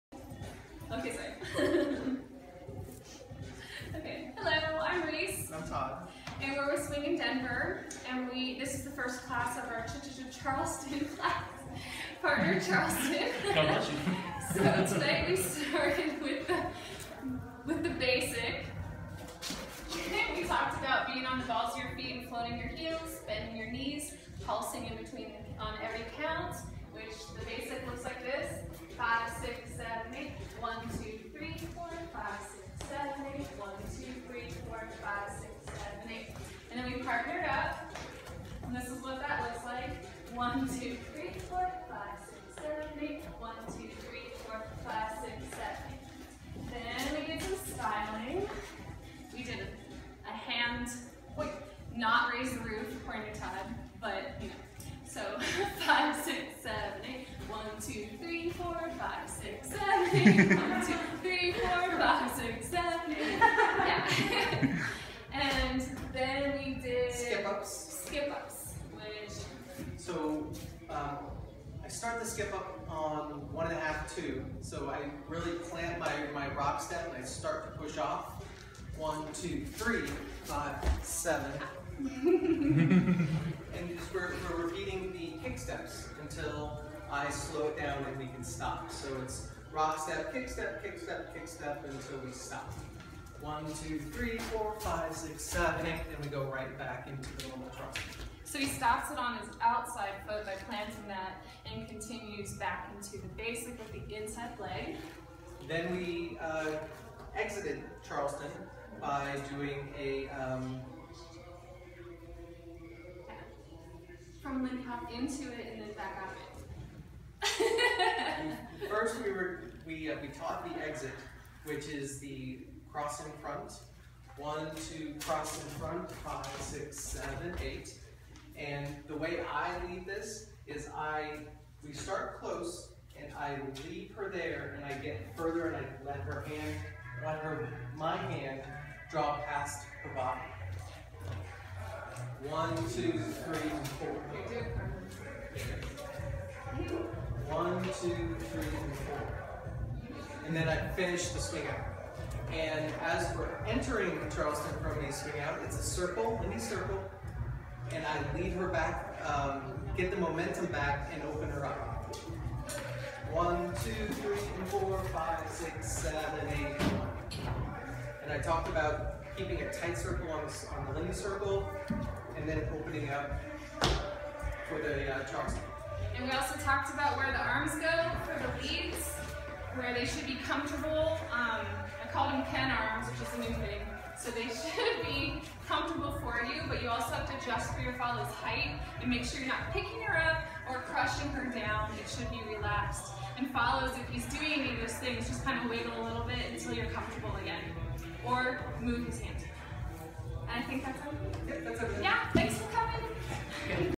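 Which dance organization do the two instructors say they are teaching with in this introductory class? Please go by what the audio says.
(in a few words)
Swingin' Denver.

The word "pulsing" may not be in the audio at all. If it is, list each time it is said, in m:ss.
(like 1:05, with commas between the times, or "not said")
0:24.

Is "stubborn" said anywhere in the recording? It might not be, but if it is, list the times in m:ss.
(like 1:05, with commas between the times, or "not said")
not said.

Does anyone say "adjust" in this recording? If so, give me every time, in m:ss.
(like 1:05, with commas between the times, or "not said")
3:07.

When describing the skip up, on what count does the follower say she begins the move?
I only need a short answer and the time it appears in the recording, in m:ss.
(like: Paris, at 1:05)
One and a half, at 1:13.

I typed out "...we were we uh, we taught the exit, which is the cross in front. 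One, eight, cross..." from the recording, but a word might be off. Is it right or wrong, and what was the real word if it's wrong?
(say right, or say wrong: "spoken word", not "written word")
wrong: "two", not "eight".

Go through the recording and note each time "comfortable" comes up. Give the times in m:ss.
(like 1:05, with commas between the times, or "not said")
3:00, 3:05, 3:16.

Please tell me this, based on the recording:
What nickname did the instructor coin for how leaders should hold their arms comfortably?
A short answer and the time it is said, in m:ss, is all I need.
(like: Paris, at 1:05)
Ken arms, at 3:02.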